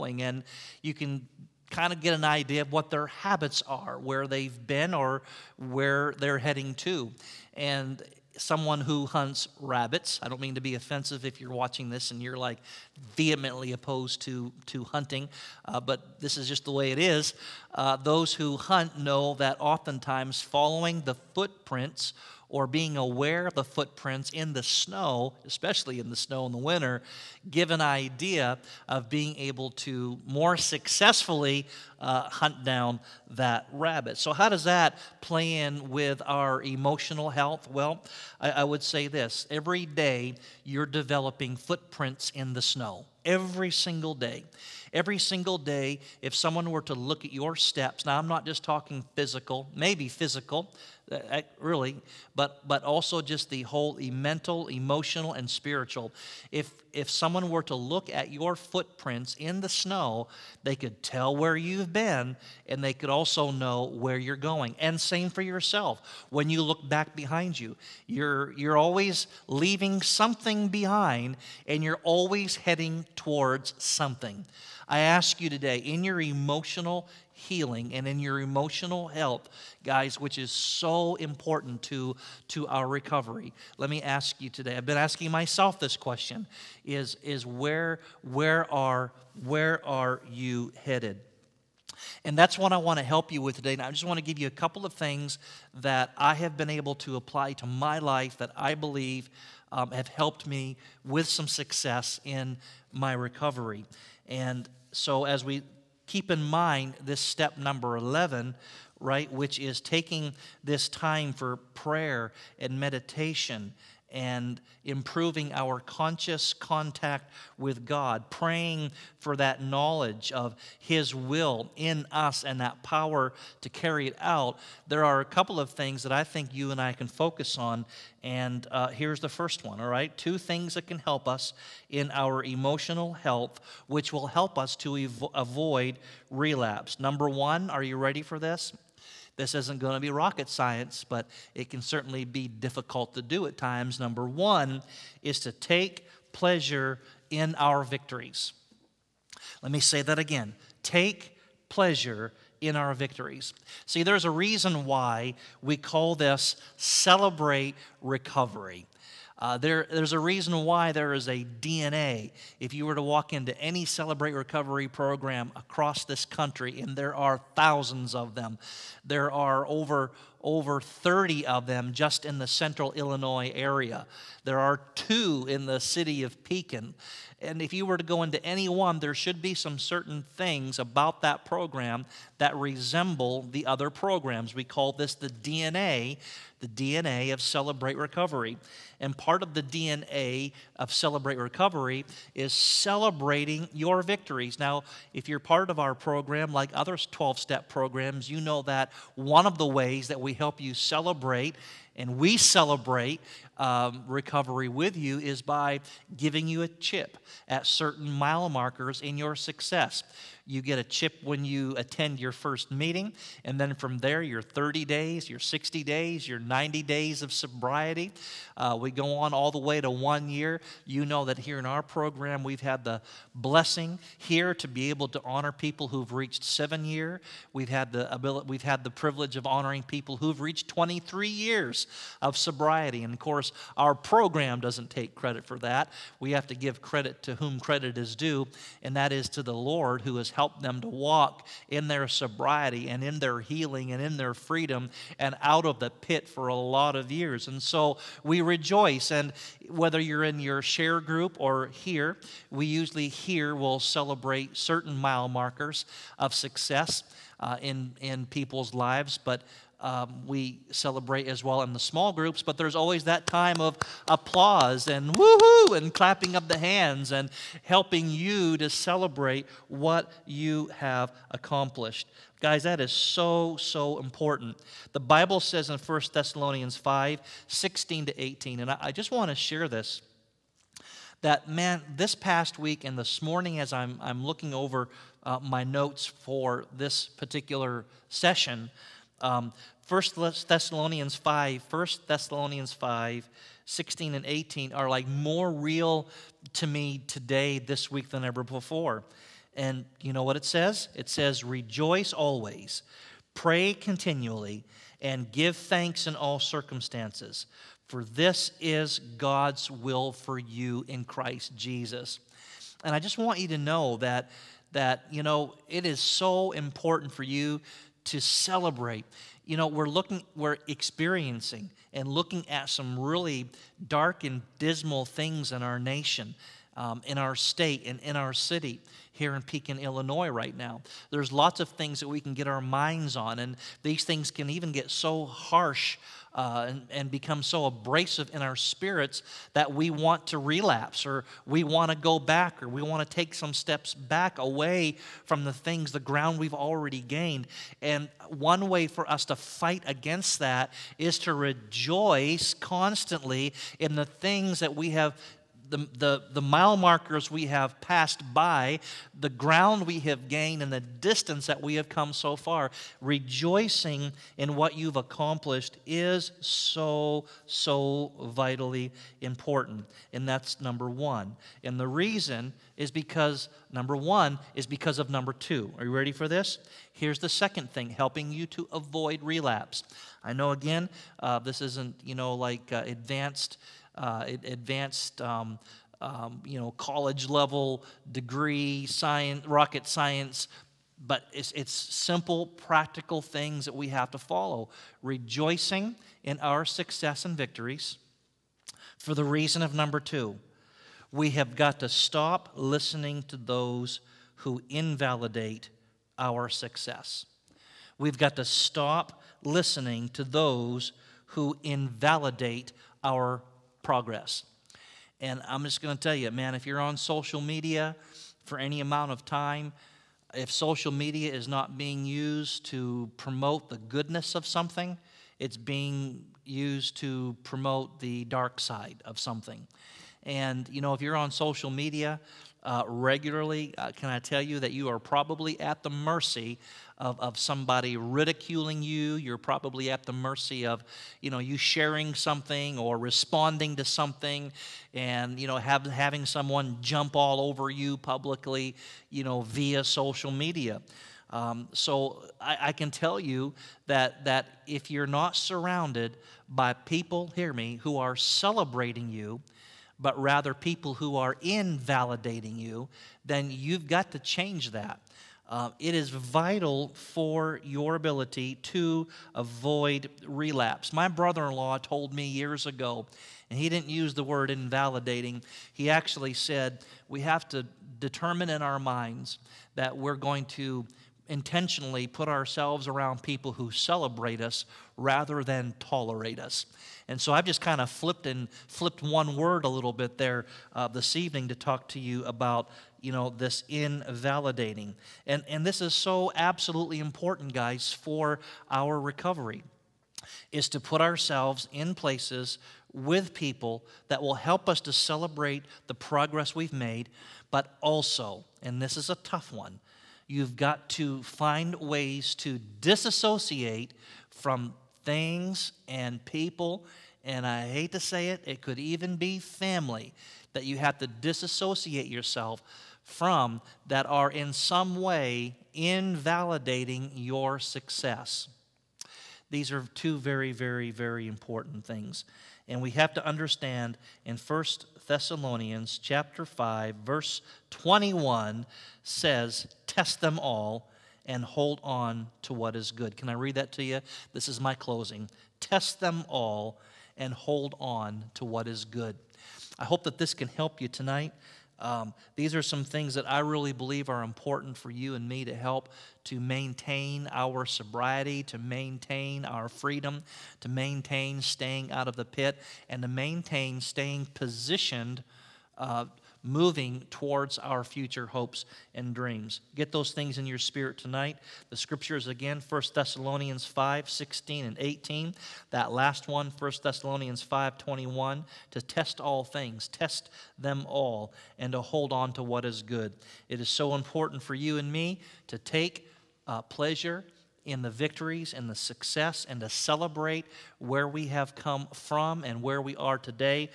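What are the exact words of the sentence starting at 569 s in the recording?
Get those things in your spirit tonight.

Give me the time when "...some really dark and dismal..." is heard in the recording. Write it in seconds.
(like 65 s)
322 s.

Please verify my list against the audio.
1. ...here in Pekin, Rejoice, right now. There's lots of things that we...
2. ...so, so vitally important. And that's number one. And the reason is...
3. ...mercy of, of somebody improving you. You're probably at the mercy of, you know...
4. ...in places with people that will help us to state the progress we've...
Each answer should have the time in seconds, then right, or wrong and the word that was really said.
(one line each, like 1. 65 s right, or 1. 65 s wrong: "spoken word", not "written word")
1. 329 s wrong: "Illinois", not "Rejoice"
2. 366 s right
3. 435 s wrong: "ridiculing", not "improving"
4. 501 s wrong: "celebrate", not "state".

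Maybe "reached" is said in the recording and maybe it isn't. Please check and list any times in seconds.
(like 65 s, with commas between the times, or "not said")
226 s, 230 s.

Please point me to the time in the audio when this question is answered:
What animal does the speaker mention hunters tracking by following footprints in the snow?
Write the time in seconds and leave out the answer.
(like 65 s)
9 s.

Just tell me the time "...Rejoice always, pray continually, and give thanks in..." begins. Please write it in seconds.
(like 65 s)
301 s.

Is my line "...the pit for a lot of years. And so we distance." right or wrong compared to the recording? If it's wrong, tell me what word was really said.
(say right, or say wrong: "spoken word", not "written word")
wrong: "rejoice", not "distance".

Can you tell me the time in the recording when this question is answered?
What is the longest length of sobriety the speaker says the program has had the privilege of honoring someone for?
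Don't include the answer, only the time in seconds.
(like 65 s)
230 s.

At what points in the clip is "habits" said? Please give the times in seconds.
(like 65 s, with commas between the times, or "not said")
3 s.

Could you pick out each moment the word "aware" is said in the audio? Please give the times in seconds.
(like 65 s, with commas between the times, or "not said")
22 s.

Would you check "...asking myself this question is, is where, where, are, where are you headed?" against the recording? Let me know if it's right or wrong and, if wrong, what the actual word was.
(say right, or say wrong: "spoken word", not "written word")
right.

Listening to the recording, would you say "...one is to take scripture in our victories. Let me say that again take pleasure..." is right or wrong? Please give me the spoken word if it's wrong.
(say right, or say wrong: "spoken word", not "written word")
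wrong: "pleasure", not "scripture".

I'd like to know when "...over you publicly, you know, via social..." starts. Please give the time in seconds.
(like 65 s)
447 s.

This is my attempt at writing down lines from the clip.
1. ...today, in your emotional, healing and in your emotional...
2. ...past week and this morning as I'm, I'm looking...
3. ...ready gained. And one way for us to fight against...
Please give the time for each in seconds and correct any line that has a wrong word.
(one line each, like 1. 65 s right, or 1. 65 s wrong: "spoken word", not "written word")
1. 75 s right
2. 282 s right
3. 346 s wrong: "already", not "ready".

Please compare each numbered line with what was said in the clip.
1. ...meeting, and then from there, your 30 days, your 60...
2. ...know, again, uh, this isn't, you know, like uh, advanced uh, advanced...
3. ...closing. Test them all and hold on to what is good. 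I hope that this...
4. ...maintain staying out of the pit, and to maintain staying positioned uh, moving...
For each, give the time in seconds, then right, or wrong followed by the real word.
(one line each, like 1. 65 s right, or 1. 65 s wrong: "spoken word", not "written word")
1. 212 s right
2. 380 s right
3. 544 s right
4. 560 s right.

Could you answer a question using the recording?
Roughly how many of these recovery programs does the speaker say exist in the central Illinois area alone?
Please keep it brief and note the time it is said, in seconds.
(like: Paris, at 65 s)
Over 30, at 169 s.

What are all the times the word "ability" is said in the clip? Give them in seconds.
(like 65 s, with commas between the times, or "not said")
228 s, 467 s.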